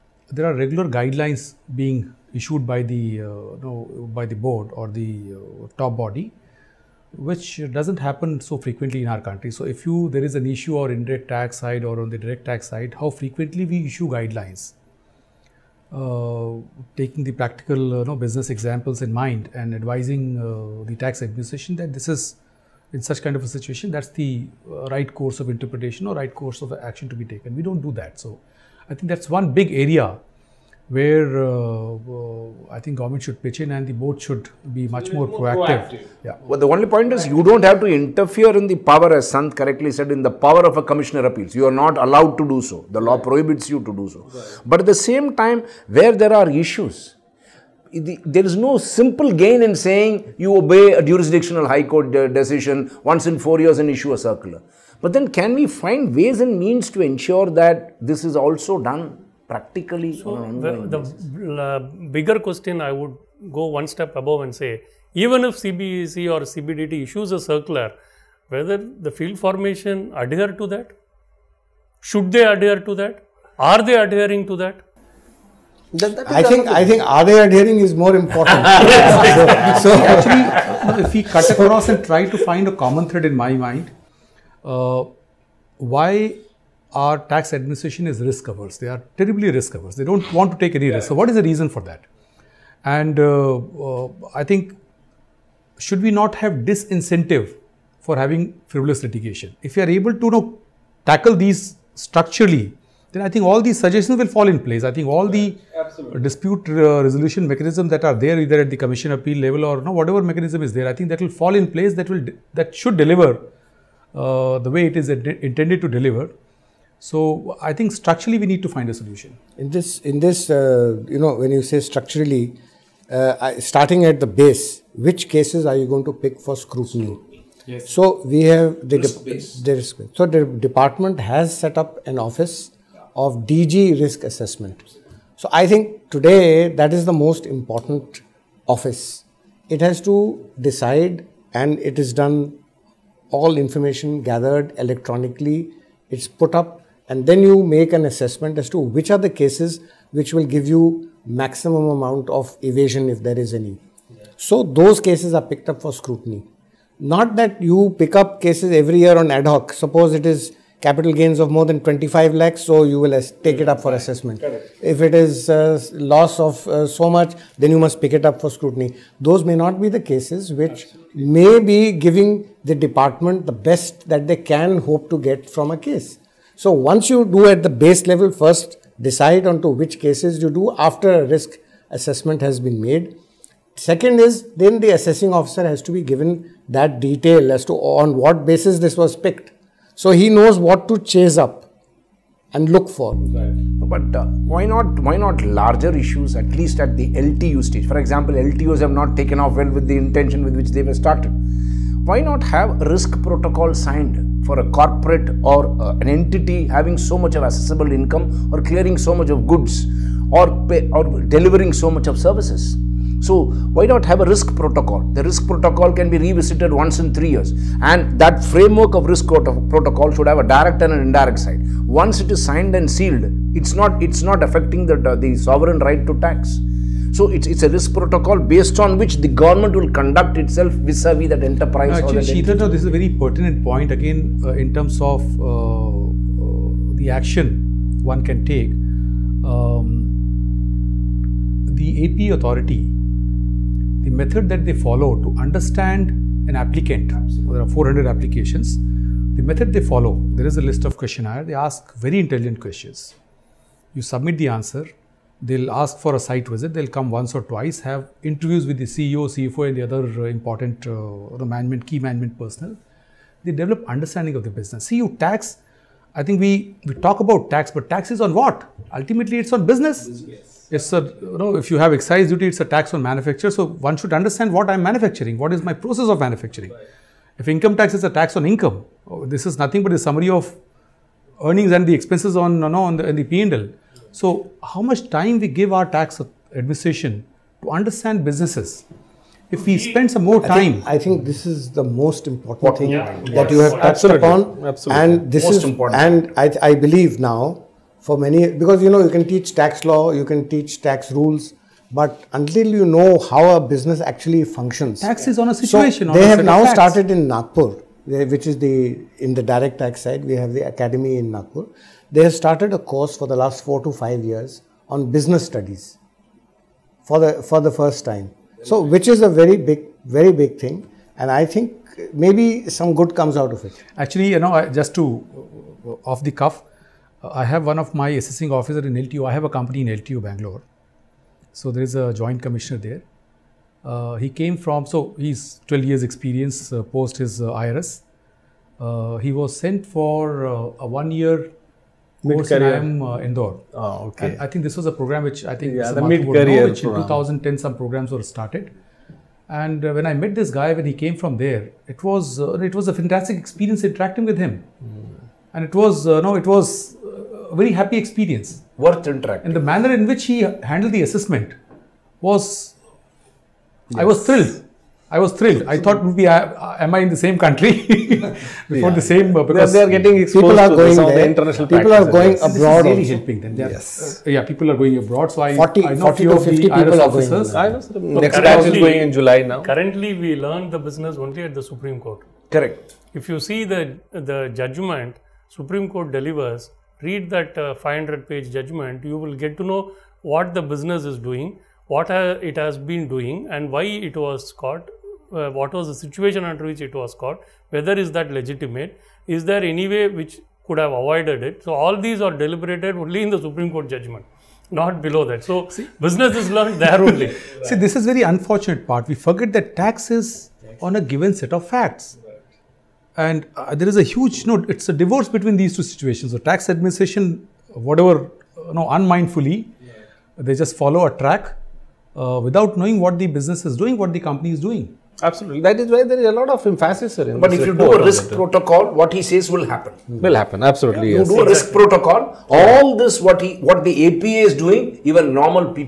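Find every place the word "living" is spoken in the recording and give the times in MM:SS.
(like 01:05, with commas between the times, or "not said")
not said.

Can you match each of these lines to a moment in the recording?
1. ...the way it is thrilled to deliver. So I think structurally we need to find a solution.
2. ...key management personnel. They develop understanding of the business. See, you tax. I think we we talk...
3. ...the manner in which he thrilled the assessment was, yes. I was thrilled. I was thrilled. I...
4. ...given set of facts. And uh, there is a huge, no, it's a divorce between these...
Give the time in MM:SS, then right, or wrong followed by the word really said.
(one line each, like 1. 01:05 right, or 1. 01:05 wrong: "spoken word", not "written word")
1. 01:54 wrong: "intended", not "thrilled"
2. 04:21 right
3. 05:59 wrong: "handled", not "thrilled"
4. 06:51 right.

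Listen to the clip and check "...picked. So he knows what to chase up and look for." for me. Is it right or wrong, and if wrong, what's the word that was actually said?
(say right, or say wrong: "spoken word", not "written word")
right.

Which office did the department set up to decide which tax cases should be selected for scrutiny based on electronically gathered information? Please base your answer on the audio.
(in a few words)
DG risk assessment.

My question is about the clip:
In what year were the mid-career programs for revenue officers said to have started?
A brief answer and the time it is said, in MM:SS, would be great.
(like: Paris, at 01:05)
2010, at 05:46.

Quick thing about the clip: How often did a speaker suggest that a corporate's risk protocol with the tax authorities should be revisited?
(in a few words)
once in three years.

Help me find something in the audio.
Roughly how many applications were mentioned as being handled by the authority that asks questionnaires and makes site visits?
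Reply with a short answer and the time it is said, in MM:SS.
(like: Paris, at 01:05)
400, at 04:07.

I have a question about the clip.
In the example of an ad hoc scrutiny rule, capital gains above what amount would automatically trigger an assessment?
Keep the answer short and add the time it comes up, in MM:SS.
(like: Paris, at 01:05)
25 lakhs, at 02:41.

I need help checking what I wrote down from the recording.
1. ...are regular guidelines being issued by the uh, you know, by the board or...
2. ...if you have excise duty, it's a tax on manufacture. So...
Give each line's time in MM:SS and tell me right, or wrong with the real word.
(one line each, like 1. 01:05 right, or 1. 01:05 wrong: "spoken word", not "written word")
1. 00:00 right
2. 04:31 right.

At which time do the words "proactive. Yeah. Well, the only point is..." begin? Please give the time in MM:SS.
00:35.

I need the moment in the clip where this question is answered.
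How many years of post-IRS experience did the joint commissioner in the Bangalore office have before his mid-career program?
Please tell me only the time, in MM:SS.
05:35.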